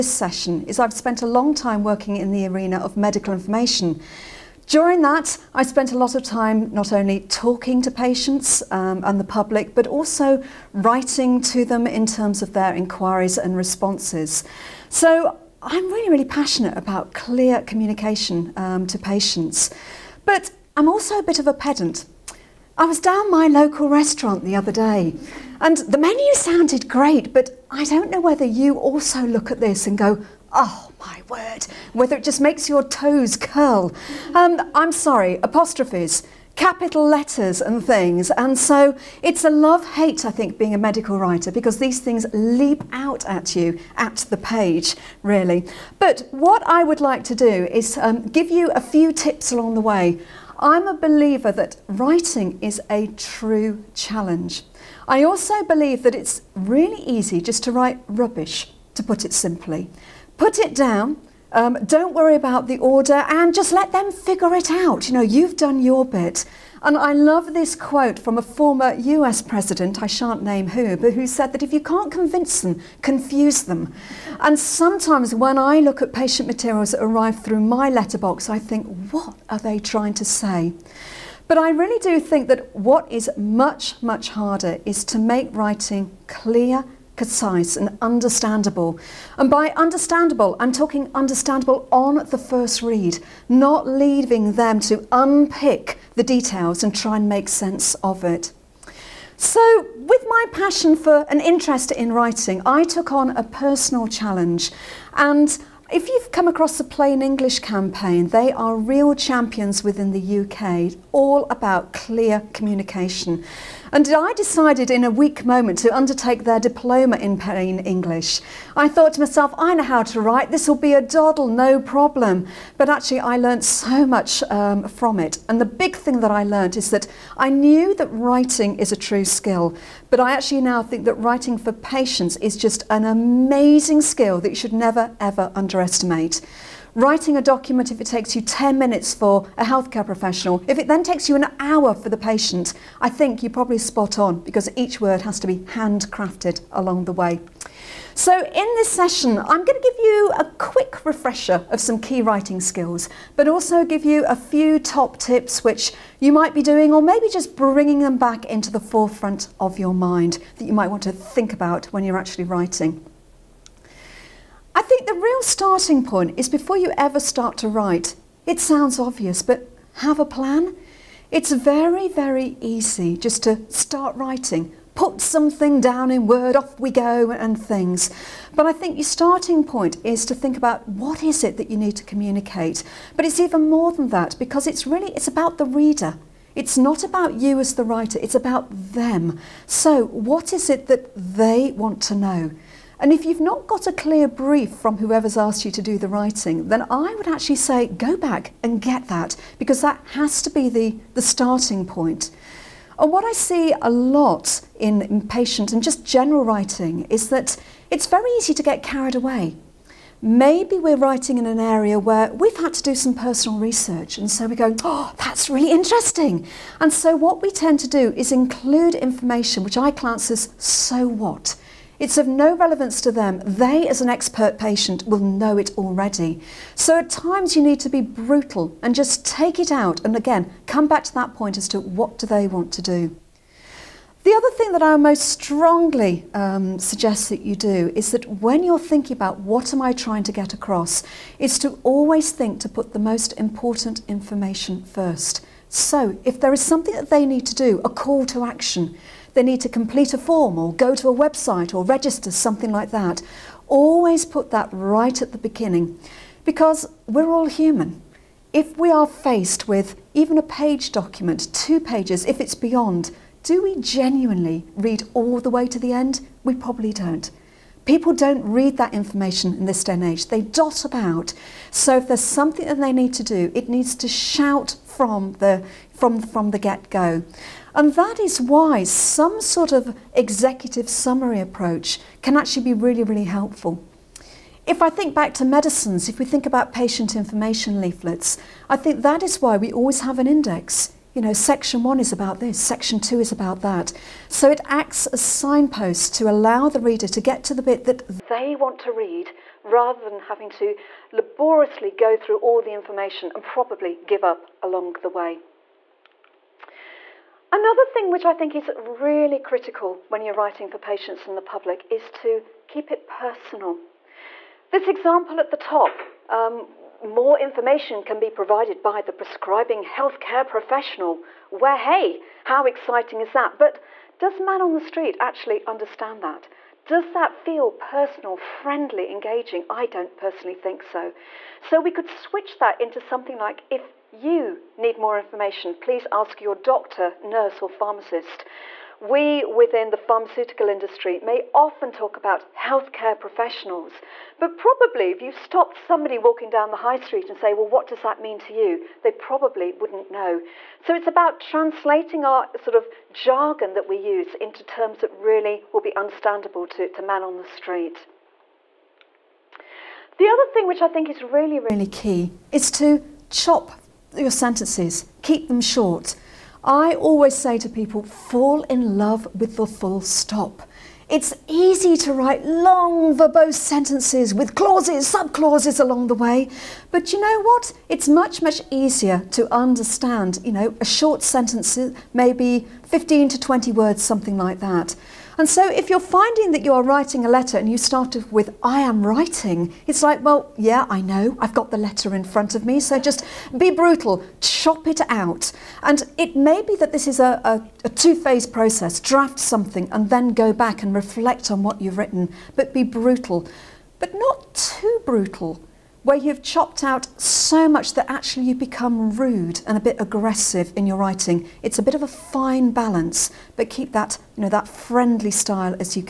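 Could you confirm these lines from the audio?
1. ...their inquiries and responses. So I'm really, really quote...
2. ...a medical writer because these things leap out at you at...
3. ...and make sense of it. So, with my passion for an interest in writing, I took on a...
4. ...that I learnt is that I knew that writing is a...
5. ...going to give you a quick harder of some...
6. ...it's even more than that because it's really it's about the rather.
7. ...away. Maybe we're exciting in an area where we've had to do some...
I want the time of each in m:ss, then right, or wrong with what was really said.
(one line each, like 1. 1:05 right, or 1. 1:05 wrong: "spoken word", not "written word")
1. 0:12 wrong: "passionate", not "quote"
2. 0:40 right
3. 1:37 right
4. 2:06 right
5. 2:29 wrong: "refresher", not "harder"
6. 3:03 wrong: "reader", not "rather"
7. 3:29 wrong: "writing", not "exciting".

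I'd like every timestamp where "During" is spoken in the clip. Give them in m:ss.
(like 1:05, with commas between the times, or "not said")
0:04.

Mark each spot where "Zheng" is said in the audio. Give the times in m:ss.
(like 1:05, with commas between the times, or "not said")
not said.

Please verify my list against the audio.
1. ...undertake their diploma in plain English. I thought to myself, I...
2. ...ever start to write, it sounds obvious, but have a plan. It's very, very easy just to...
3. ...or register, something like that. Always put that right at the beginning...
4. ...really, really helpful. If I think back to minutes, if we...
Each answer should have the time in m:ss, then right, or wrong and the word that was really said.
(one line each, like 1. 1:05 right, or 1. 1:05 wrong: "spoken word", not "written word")
1. 1:55 right
2. 2:46 right
3. 4:11 right
4. 4:42 wrong: "medicines", not "minutes".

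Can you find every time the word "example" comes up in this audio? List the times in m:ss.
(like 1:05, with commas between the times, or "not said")
5:14.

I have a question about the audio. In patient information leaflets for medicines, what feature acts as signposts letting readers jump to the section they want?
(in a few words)
an index.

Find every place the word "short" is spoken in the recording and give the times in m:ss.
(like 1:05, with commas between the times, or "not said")
6:05, 6:20.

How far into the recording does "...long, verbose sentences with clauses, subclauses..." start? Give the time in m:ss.
6:12.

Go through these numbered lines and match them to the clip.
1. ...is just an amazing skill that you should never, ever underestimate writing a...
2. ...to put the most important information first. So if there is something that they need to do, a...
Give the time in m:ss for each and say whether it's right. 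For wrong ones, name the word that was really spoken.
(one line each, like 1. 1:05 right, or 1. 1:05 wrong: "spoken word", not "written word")
1. 2:12 right
2. 4:02 right.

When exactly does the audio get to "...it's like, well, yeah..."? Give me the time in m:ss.
6:29.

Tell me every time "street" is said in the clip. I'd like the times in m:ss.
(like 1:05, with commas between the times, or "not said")
5:24, 5:46, 5:57.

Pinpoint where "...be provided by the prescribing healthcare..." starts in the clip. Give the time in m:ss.
5:18.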